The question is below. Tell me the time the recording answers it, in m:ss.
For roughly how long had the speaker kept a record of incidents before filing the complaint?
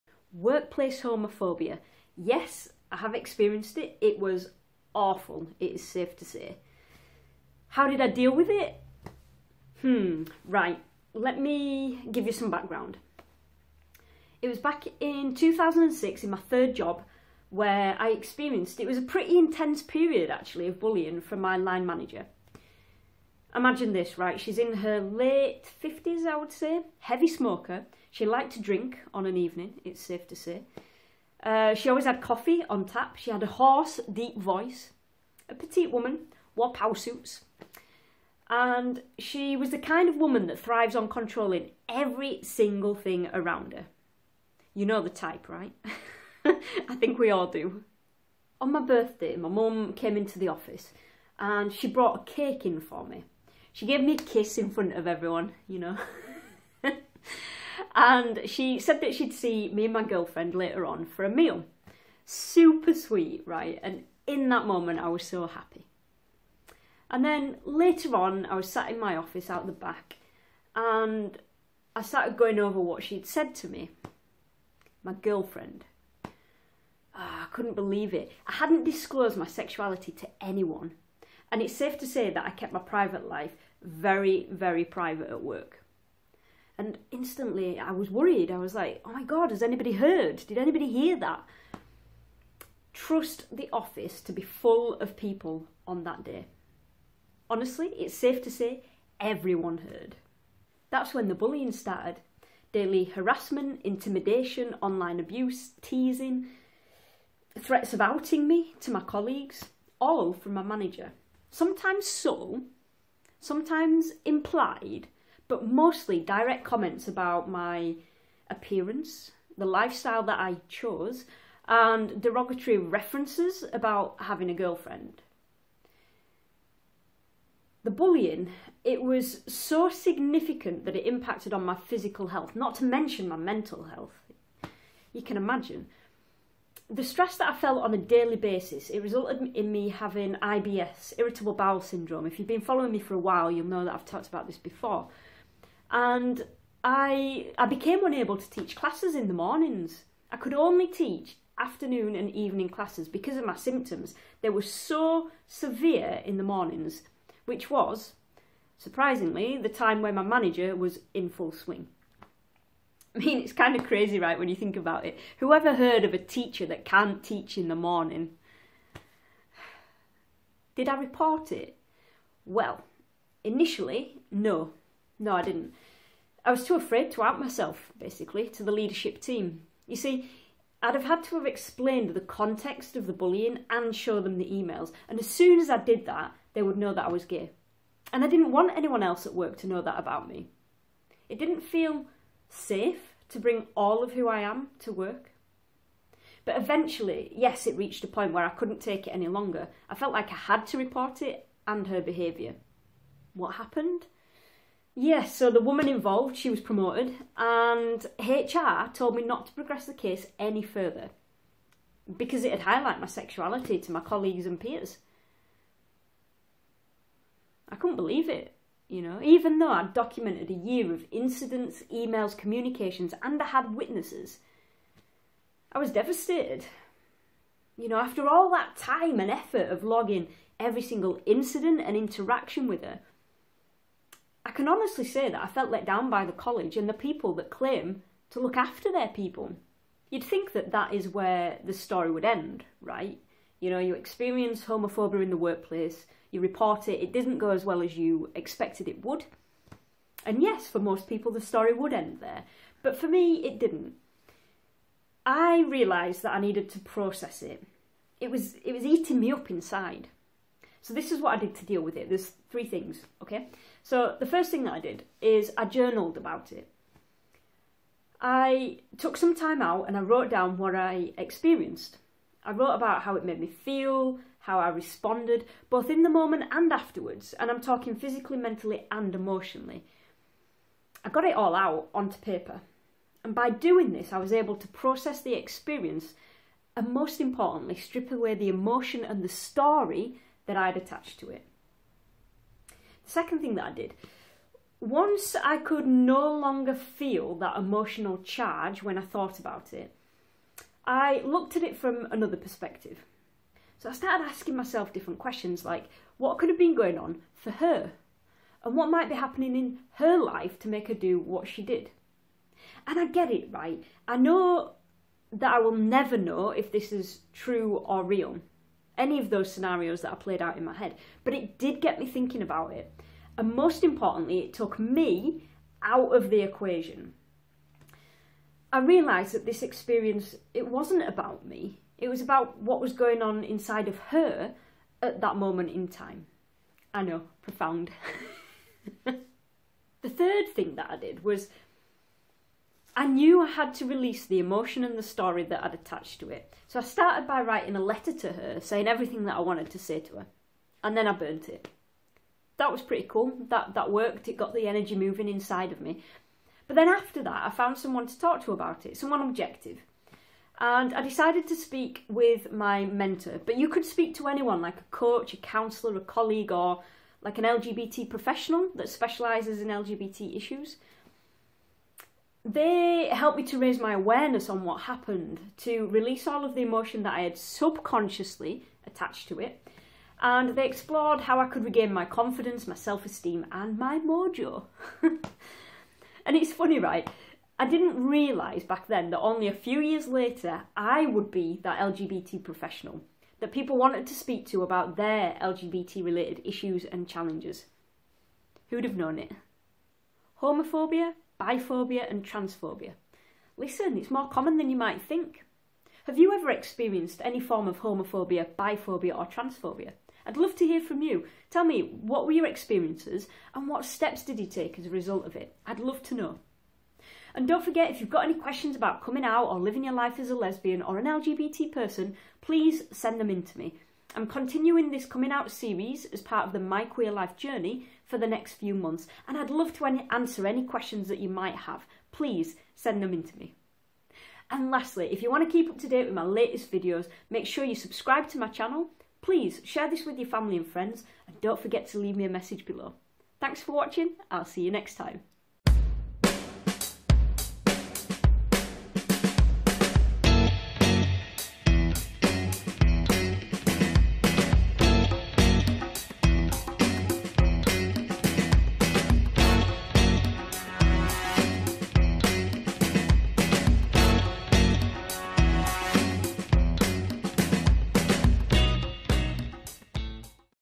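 3:40.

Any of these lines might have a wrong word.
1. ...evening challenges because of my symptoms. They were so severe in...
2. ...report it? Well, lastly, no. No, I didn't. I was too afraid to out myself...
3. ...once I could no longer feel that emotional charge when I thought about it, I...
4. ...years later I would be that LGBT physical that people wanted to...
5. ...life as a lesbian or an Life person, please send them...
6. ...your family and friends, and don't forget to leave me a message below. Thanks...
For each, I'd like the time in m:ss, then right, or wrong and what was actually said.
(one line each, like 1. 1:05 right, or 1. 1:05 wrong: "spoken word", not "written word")
1. 2:32 wrong: "classes", not "challenges"
2. 2:50 wrong: "initially", not "lastly"
3. 4:54 right
4. 6:29 wrong: "professional", not "physical"
5. 6:59 wrong: "LGBT", not "Life"
6. 7:20 right.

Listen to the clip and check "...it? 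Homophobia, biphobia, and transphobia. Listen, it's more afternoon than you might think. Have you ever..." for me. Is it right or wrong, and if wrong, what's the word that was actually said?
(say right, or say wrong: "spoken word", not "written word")
wrong: "common", not "afternoon".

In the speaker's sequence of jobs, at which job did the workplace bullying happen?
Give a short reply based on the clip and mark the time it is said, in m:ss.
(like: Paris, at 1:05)
third job, at 0:16.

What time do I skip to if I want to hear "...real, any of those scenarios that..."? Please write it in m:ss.
5:18.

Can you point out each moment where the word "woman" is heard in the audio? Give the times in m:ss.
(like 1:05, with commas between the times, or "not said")
0:35, 0:40, 3:25.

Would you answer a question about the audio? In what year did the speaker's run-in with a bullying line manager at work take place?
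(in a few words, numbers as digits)
2006.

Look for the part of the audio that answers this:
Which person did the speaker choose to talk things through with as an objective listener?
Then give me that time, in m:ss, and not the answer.
6:02.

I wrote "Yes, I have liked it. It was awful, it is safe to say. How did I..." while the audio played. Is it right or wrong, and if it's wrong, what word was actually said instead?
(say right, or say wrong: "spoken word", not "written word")
wrong: "experienced", not "liked".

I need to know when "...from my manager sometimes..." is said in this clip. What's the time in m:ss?
1:50.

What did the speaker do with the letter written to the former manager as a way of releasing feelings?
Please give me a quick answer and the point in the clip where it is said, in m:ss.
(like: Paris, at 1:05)
burnt it, at 5:51.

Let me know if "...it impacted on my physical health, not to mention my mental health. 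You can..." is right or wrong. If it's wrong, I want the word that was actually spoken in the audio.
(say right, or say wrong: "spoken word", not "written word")
right.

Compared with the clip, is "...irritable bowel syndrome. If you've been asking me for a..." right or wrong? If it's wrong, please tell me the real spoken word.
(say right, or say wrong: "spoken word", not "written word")
wrong: "following", not "asking".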